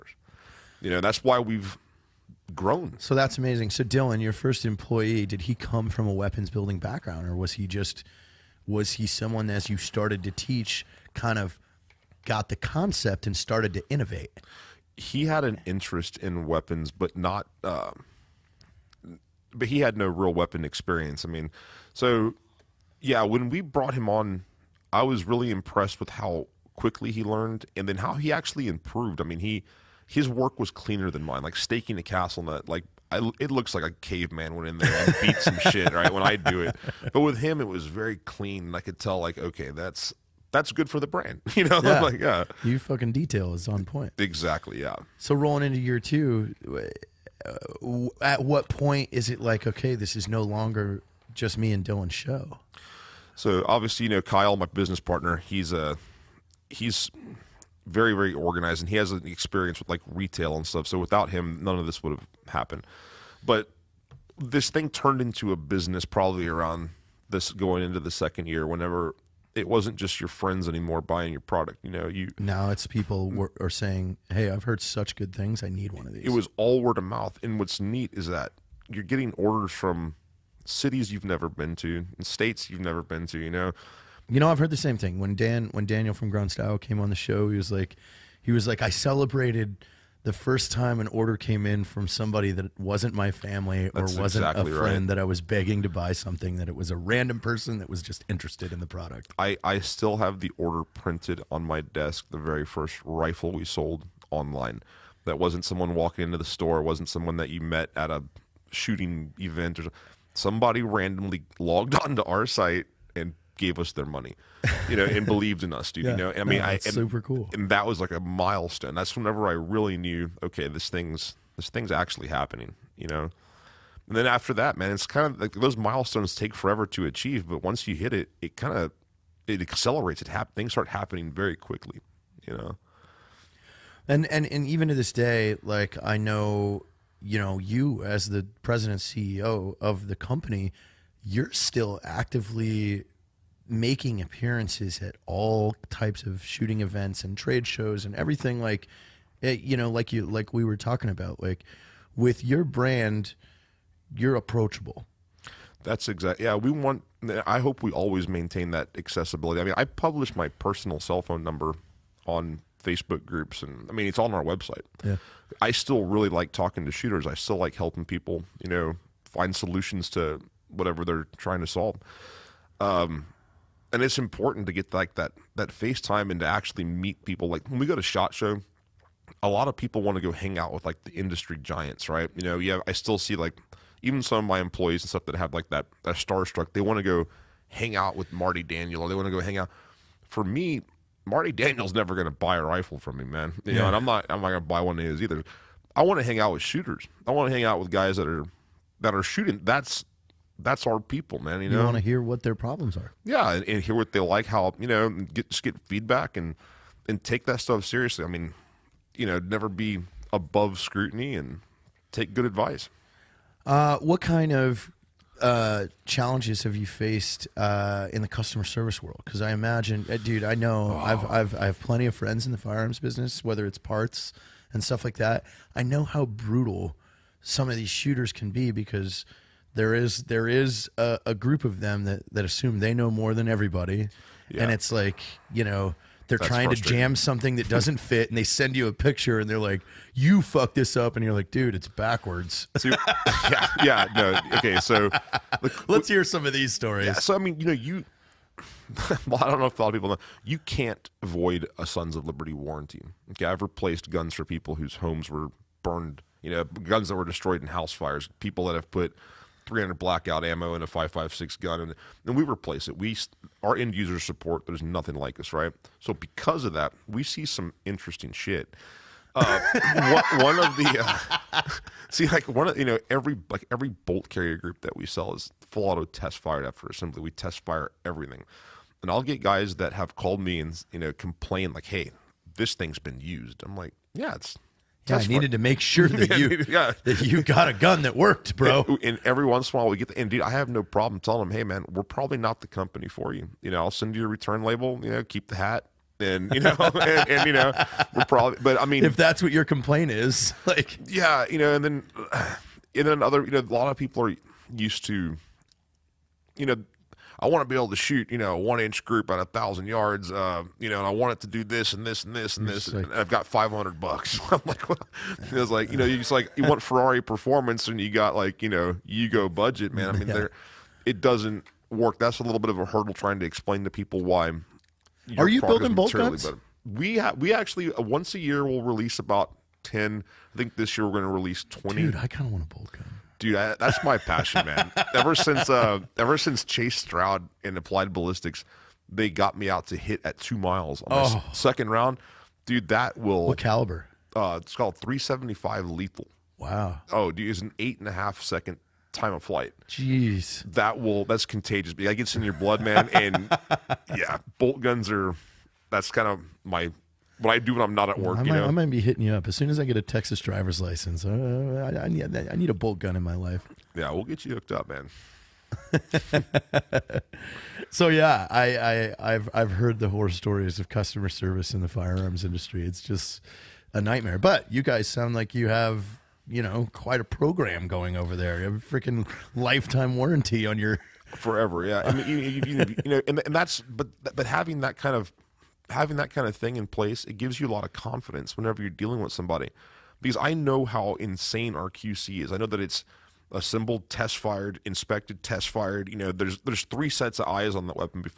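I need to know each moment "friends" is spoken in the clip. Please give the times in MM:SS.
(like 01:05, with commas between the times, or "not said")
01:10, 01:34, 03:42.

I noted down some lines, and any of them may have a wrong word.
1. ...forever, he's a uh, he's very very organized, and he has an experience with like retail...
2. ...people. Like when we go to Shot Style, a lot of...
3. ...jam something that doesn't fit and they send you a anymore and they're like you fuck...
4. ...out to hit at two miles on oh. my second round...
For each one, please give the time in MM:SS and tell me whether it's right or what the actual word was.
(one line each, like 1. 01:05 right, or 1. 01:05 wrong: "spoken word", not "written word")
1. 00:55 wrong: "partner", not "forever"
2. 02:57 wrong: "Show", not "Style"
3. 03:56 wrong: "picture", not "anymore"
4. 05:39 right.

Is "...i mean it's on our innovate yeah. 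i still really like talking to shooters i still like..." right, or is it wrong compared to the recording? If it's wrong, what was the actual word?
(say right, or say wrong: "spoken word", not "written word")
wrong: "website", not "innovate".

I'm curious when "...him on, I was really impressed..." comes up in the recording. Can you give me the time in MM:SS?
00:23.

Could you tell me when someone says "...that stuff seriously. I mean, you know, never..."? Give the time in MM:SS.
03:27.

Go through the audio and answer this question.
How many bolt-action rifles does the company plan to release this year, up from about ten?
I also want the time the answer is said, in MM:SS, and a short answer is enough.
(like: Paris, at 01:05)
20, at 05:31.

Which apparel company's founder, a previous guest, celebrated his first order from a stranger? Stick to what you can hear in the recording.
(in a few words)
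Grunt Style.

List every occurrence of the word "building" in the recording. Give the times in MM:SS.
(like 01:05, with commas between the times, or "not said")
00:06, 05:25.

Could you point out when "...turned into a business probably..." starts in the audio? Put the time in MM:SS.
01:04.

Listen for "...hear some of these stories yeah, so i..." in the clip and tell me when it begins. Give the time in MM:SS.
04:06.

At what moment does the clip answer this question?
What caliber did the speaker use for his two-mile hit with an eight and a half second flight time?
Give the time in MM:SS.
05:44.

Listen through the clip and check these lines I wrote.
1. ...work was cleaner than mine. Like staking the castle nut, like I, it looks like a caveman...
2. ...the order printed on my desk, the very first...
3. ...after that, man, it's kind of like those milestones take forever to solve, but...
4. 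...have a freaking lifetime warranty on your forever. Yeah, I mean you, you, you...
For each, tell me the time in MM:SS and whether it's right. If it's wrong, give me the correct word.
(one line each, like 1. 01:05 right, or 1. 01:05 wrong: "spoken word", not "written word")
1. 00:30 right
2. 01:40 right
3. 02:04 wrong: "achieve", not "solve"
4. 06:18 right.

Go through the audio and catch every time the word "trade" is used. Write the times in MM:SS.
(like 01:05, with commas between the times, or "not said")
02:27.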